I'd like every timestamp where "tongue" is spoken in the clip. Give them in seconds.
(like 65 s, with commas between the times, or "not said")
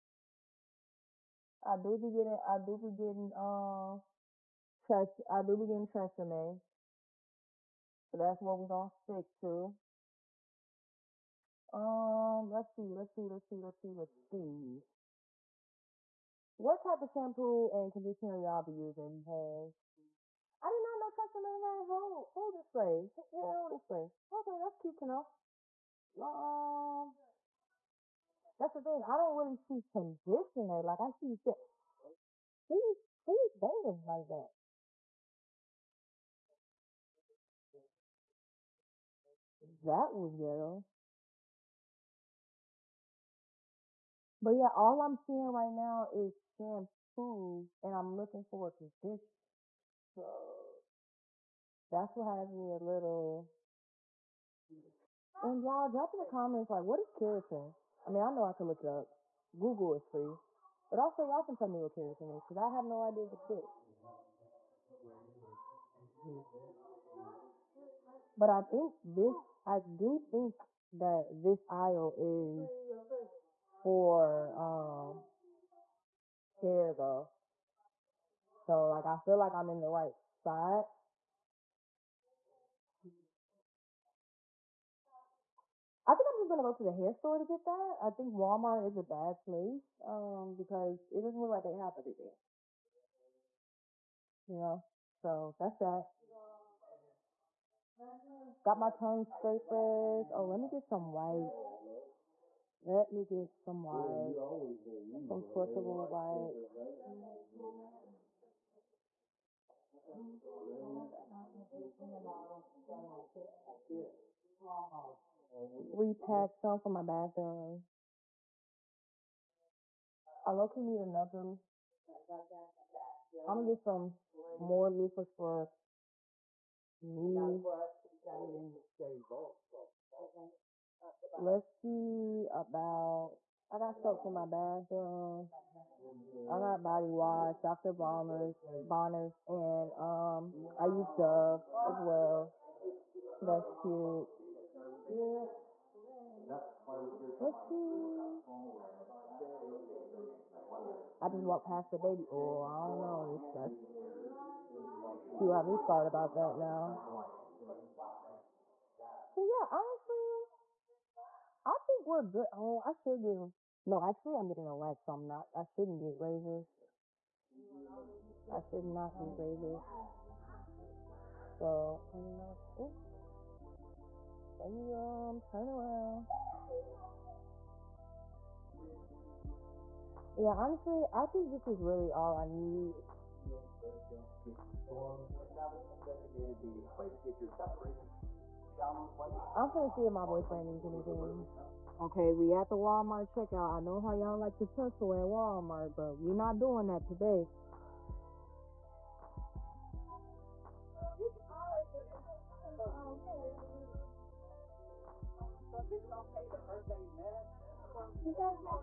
98 s.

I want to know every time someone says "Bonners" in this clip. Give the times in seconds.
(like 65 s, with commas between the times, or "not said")
138 s.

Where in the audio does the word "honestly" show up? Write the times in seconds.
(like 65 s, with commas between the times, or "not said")
159 s, 180 s.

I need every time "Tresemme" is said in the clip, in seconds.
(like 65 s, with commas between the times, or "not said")
6 s, 21 s.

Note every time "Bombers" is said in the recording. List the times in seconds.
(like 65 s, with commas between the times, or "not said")
137 s.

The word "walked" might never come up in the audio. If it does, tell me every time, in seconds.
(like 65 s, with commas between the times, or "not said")
151 s.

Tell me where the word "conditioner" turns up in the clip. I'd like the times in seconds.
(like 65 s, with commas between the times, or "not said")
17 s, 29 s, 48 s.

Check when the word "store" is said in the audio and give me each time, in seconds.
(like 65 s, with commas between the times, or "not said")
87 s.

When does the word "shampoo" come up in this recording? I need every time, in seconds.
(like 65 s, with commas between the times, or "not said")
17 s, 46 s.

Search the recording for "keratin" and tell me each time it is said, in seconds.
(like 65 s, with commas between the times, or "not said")
57 s, 61 s.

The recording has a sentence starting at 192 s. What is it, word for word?
Okay, we at the Walmart checkout.